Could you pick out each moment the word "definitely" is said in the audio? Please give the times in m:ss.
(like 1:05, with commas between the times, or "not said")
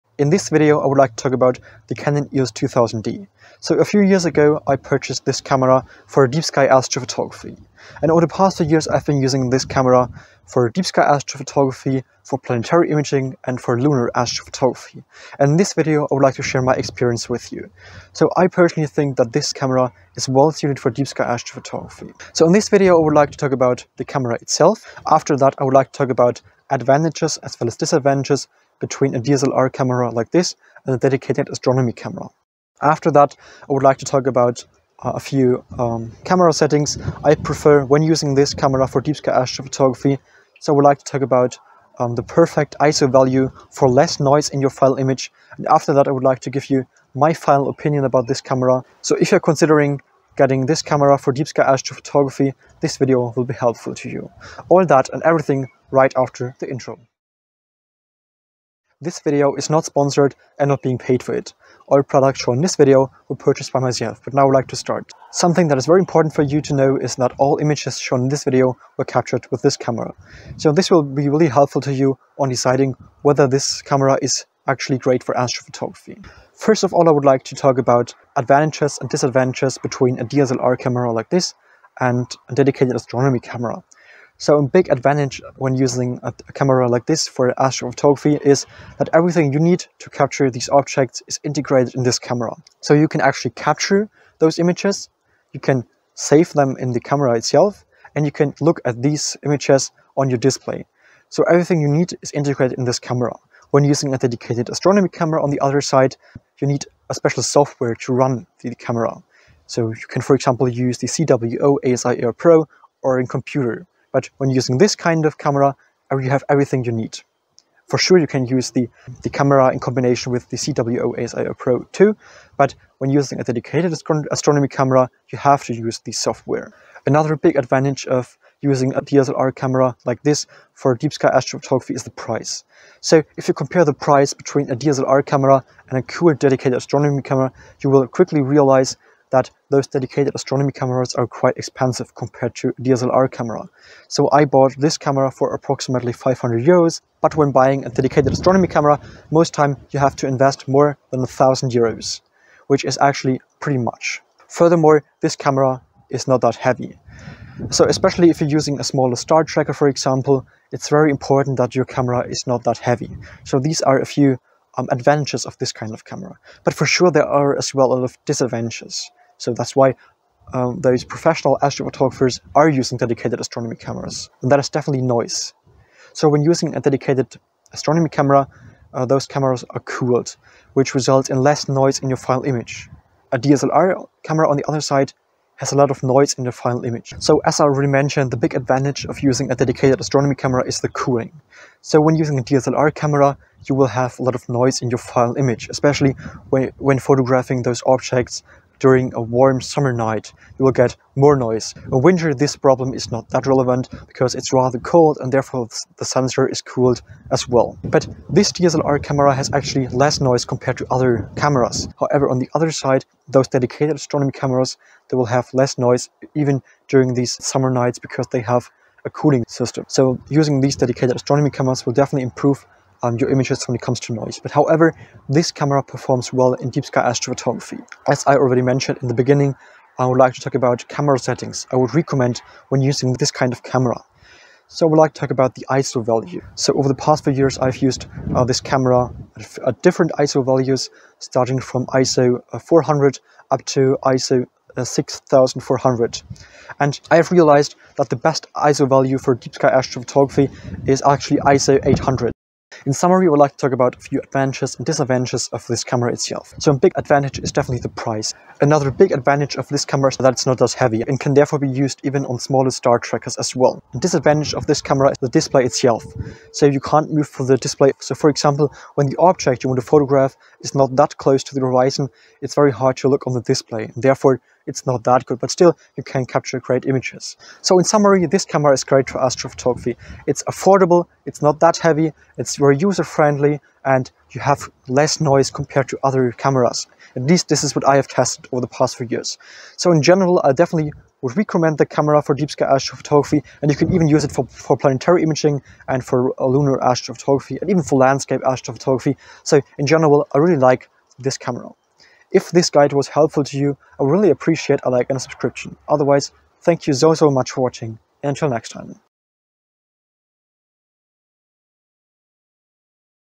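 2:54, 3:41, 4:17, 4:50.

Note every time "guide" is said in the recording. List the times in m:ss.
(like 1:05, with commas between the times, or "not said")
5:02.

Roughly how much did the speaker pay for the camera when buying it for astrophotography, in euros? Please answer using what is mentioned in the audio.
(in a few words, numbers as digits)
500 euros.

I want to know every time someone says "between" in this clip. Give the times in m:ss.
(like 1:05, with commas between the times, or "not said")
0:28, 1:19, 2:14.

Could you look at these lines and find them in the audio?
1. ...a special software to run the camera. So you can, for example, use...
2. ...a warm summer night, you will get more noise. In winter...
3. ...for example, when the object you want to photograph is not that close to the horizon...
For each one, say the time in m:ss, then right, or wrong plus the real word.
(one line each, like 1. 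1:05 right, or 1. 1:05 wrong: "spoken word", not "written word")
1. 1:47 right
2. 3:19 right
3. 4:28 right.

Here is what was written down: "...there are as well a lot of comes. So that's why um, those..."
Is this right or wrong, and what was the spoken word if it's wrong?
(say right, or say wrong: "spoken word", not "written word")
wrong: "disadvantages", not "comes".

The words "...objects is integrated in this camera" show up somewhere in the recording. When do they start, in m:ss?
1:30.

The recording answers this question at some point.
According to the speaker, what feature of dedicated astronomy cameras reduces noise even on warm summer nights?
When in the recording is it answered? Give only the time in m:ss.
3:39.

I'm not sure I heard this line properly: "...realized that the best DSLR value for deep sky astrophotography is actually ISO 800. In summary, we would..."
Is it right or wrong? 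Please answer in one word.
wrong.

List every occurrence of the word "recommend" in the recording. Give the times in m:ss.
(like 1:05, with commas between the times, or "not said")
3:51, 4:51.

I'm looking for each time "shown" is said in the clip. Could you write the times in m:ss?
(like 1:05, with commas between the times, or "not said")
1:02, 1:07.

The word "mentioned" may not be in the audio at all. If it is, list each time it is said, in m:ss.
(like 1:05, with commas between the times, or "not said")
3:07, 3:48.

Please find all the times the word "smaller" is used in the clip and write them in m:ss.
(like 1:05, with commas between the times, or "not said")
2:38, 4:22.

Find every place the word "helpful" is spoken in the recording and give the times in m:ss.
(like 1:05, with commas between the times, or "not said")
0:53, 1:11, 5:03.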